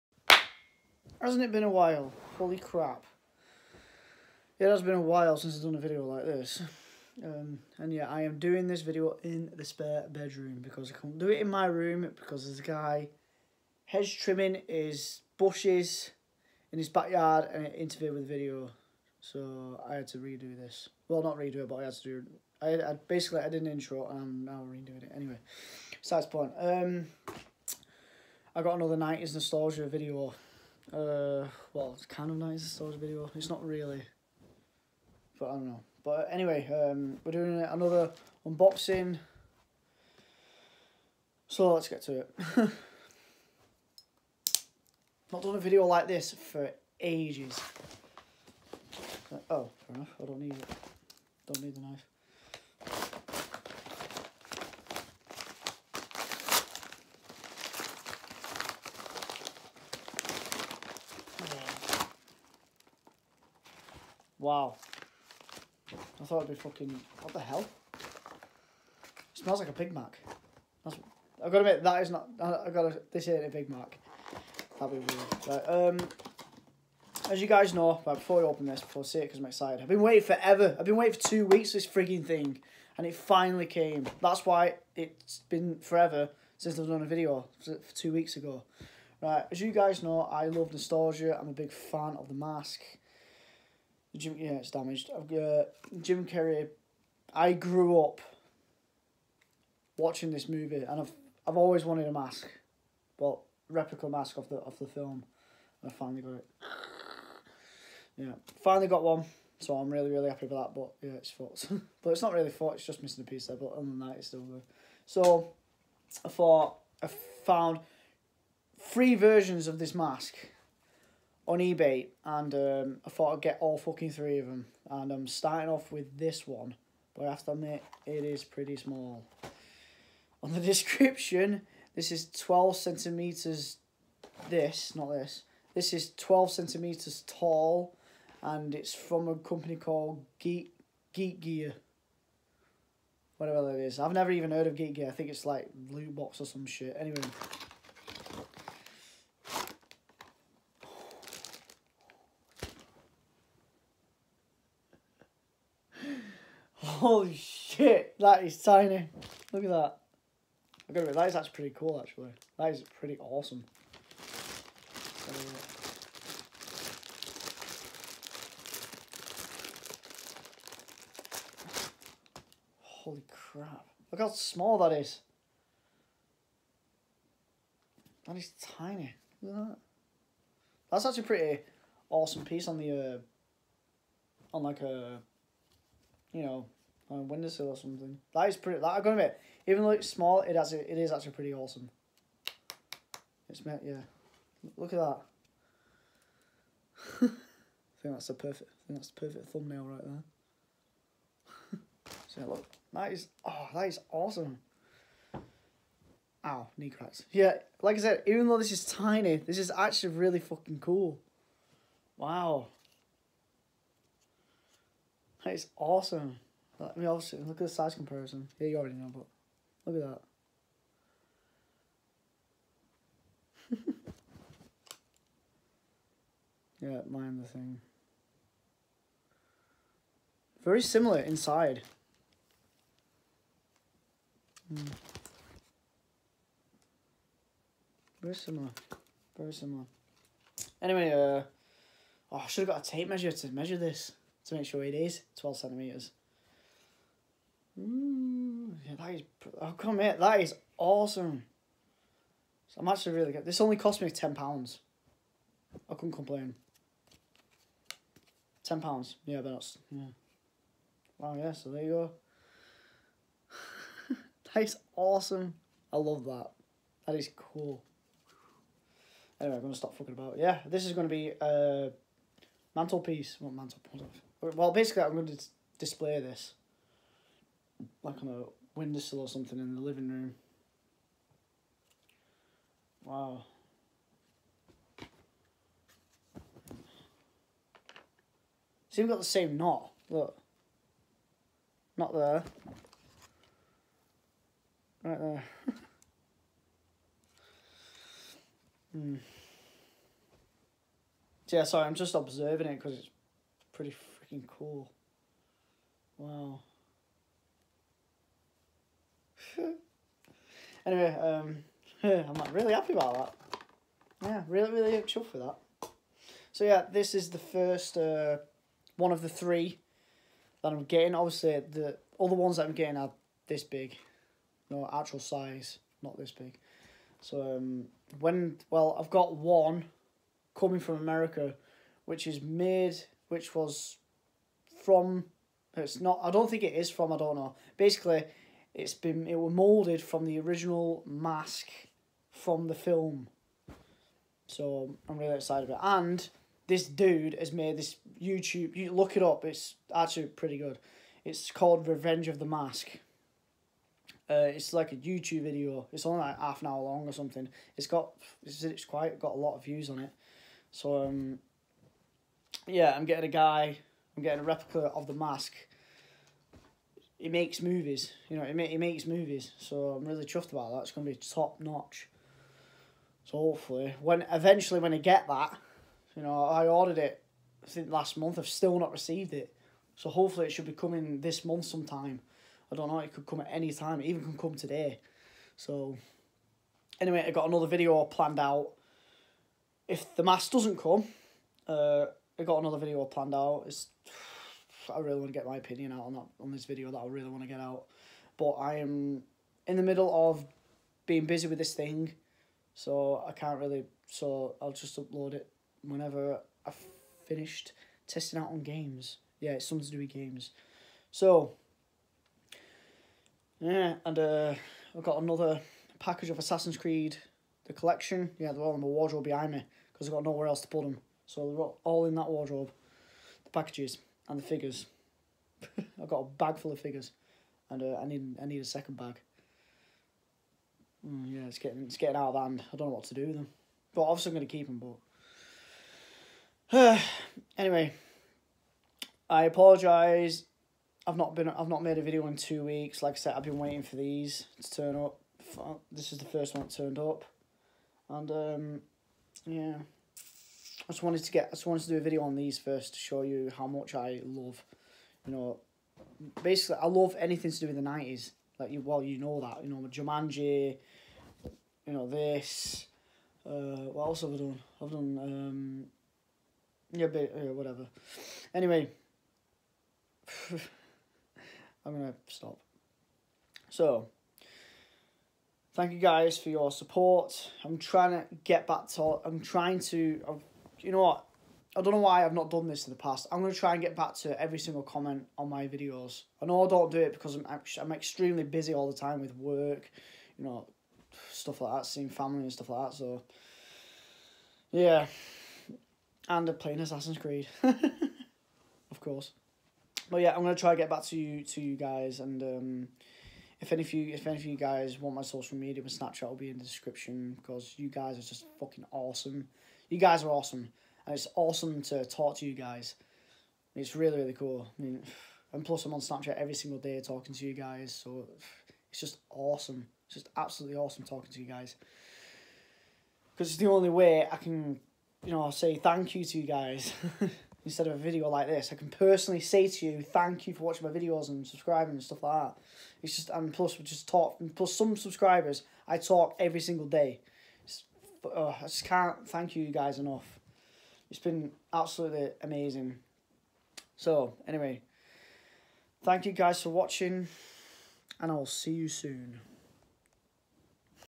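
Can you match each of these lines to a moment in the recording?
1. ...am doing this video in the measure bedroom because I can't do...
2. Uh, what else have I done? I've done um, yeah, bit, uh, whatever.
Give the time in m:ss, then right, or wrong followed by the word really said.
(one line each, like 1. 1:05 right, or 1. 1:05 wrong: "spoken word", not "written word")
1. 0:08 wrong: "spare", not "measure"
2. 7:43 right.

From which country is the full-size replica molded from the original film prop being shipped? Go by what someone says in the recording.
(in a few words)
America.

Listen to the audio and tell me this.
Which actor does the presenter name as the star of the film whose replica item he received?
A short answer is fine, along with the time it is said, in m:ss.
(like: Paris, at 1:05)
Jim Carrey, at 1:36.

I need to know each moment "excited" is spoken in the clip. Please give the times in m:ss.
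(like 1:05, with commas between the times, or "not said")
1:19, 5:45.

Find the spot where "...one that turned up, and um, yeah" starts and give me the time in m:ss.
7:26.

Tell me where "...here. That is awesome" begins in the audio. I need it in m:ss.
4:09.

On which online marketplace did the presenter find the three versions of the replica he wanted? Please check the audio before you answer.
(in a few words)
eBay.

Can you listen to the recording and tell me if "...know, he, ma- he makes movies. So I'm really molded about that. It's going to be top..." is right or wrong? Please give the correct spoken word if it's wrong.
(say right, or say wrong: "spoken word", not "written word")
wrong: "chuffed", not "molded".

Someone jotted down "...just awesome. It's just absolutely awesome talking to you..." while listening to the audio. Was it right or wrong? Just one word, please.
right.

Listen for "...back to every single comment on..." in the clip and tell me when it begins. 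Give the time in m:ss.
8:03.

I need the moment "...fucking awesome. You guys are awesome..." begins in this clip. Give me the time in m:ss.
8:28.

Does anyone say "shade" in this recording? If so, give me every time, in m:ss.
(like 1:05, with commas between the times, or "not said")
not said.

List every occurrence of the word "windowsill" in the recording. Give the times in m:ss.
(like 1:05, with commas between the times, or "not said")
3:07, 4:38.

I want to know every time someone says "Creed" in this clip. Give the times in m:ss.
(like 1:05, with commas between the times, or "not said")
6:56, 8:17.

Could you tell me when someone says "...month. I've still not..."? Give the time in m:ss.
6:18.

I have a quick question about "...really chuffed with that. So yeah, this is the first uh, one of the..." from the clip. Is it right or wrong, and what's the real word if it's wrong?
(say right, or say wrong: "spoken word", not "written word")
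right.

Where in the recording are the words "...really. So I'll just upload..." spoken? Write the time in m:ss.
6:43.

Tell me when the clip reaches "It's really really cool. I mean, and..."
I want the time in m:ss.
8:33.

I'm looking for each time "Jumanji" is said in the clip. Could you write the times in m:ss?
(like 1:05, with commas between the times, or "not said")
7:39.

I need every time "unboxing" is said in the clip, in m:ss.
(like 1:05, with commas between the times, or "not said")
0:38.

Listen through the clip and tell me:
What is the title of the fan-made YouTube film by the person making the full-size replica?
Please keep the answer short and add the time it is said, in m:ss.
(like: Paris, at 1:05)
Revenge of the Mask, at 5:51.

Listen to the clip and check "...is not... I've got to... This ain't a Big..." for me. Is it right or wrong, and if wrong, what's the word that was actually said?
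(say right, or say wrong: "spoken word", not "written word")
right.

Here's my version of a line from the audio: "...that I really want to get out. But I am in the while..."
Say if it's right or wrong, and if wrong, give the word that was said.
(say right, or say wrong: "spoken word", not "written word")
wrong: "middle", not "while".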